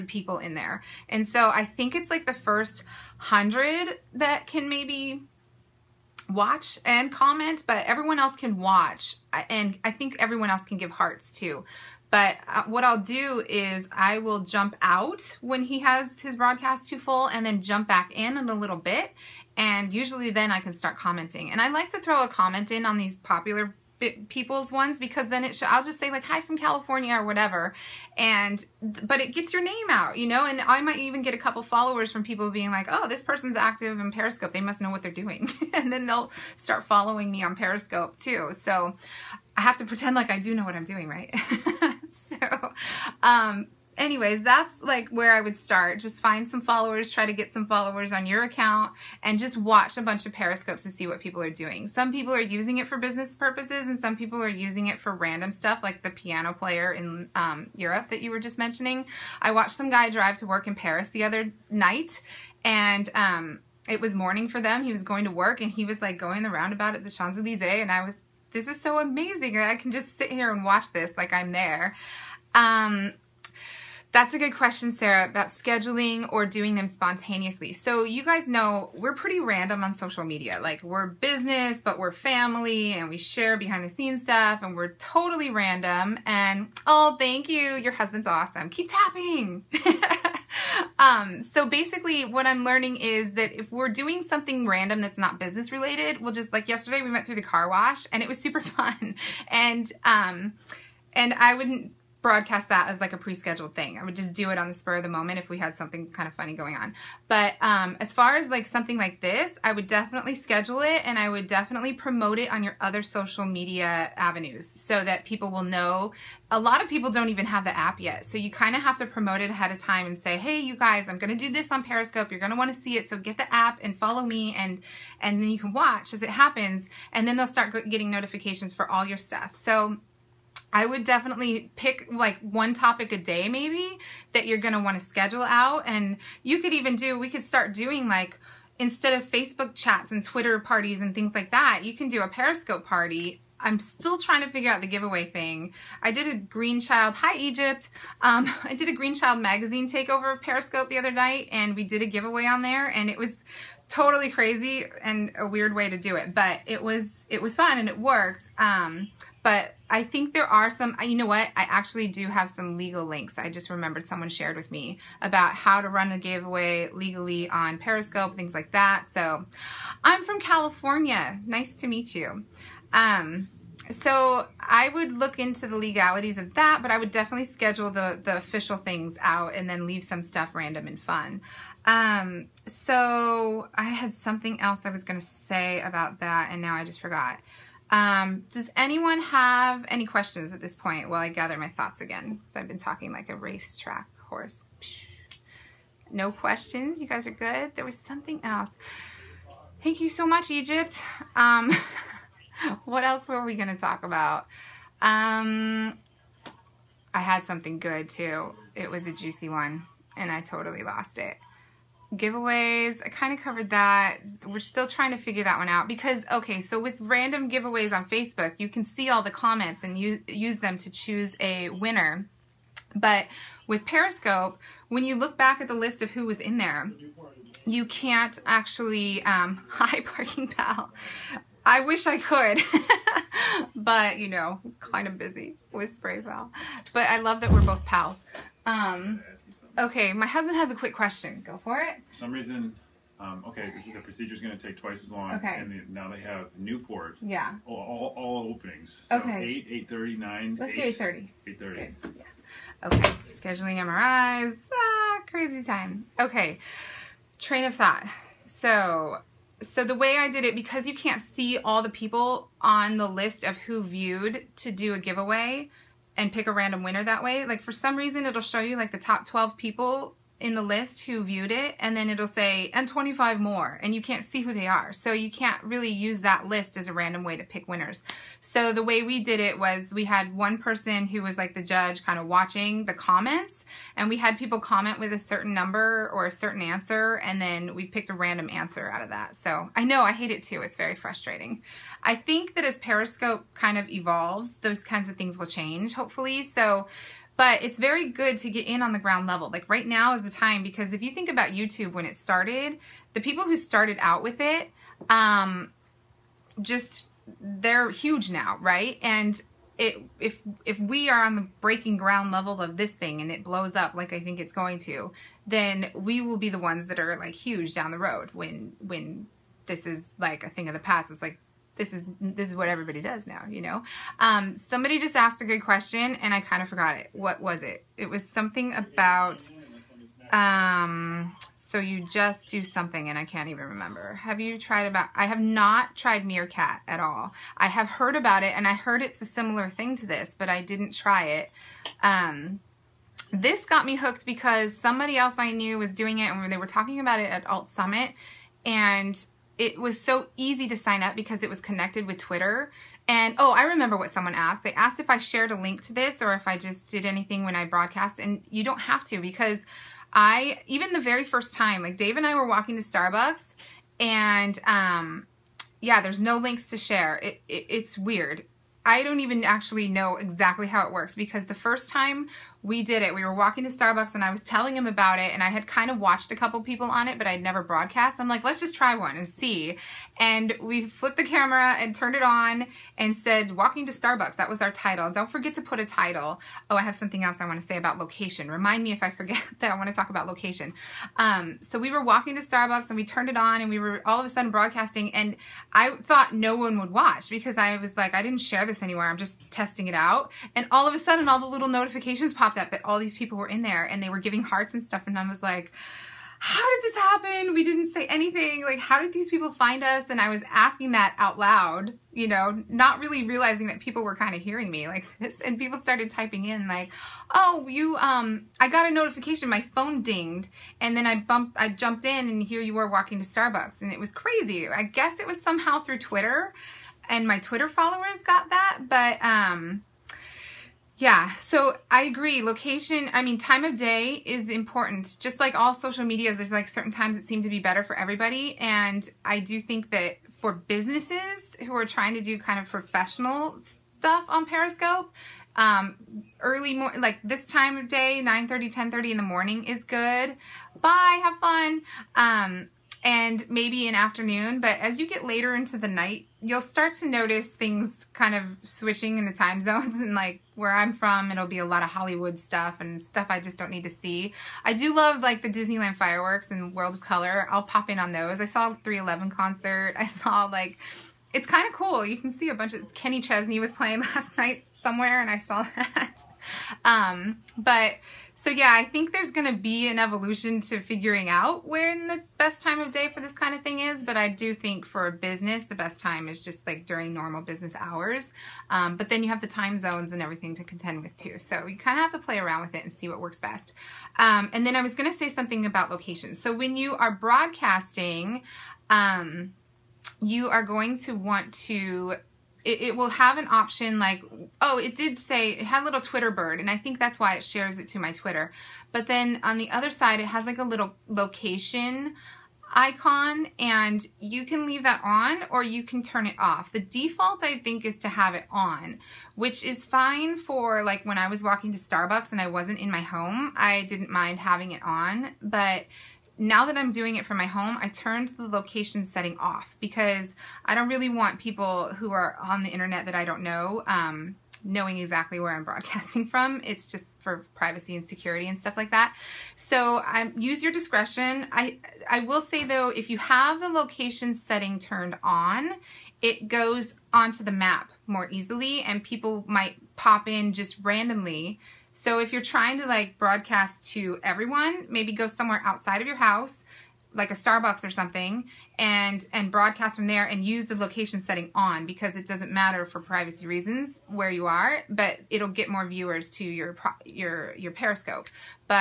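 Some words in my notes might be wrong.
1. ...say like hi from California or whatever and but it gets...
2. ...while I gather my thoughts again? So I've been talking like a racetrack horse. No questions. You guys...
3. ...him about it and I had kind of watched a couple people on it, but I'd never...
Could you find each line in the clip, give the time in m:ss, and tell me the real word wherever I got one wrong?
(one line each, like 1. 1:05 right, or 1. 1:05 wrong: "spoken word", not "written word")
1. 0:25 right
2. 3:11 right
3. 6:14 right.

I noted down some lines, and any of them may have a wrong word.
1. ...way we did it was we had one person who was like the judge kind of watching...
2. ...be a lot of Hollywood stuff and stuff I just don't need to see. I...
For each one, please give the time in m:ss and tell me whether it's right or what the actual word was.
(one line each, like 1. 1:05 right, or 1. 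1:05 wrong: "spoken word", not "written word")
1. 4:38 right
2. 7:41 right.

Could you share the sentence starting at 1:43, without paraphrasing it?
I would just do it on the spur of the moment if we had something kind of funny going on.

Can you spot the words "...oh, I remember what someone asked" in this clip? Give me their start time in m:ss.
5:53.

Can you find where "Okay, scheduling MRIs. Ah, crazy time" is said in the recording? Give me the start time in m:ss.
4:12.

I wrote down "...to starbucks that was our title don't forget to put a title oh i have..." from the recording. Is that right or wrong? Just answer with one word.
right.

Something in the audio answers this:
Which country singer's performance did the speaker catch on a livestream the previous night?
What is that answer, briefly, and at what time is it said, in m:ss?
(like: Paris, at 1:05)
Kenny Chesney, at 7:52.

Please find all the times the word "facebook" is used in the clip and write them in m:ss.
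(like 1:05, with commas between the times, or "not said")
2:19, 3:38.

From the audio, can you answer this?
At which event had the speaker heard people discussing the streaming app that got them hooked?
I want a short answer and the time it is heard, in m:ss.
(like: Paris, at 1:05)
Alt Summit, at 5:47.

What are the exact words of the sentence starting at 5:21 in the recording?
It's like this is this is what everybody does now, you know.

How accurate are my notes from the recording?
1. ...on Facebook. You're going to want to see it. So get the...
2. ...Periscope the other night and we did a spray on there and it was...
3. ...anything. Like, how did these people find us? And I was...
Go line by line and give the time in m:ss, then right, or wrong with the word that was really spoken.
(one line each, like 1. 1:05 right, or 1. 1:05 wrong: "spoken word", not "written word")
1. 2:01 wrong: "Periscope", not "Facebook"
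2. 2:30 wrong: "giveaway", not "spray"
3. 6:48 right.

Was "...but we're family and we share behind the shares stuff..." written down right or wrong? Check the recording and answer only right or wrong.
wrong.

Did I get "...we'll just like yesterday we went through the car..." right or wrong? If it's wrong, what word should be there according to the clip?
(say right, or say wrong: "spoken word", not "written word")
right.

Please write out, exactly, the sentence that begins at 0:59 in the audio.
I watched some guy drive to work in Paris the other night, and um, it was morning for them.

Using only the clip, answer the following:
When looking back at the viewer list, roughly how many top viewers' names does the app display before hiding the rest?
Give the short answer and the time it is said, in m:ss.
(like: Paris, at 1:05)
12, at 4:28.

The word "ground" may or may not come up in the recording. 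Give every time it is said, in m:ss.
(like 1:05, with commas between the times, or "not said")
4:58, 5:11.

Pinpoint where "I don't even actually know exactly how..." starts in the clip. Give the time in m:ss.
6:08.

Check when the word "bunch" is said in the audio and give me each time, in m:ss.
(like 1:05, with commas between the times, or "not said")
0:50, 7:52.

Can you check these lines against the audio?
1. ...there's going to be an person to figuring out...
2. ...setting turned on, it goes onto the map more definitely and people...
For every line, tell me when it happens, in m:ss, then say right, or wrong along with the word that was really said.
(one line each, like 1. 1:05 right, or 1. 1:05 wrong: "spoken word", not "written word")
1. 7:59 wrong: "evolution", not "person"
2. 9:04 wrong: "easily", not "definitely".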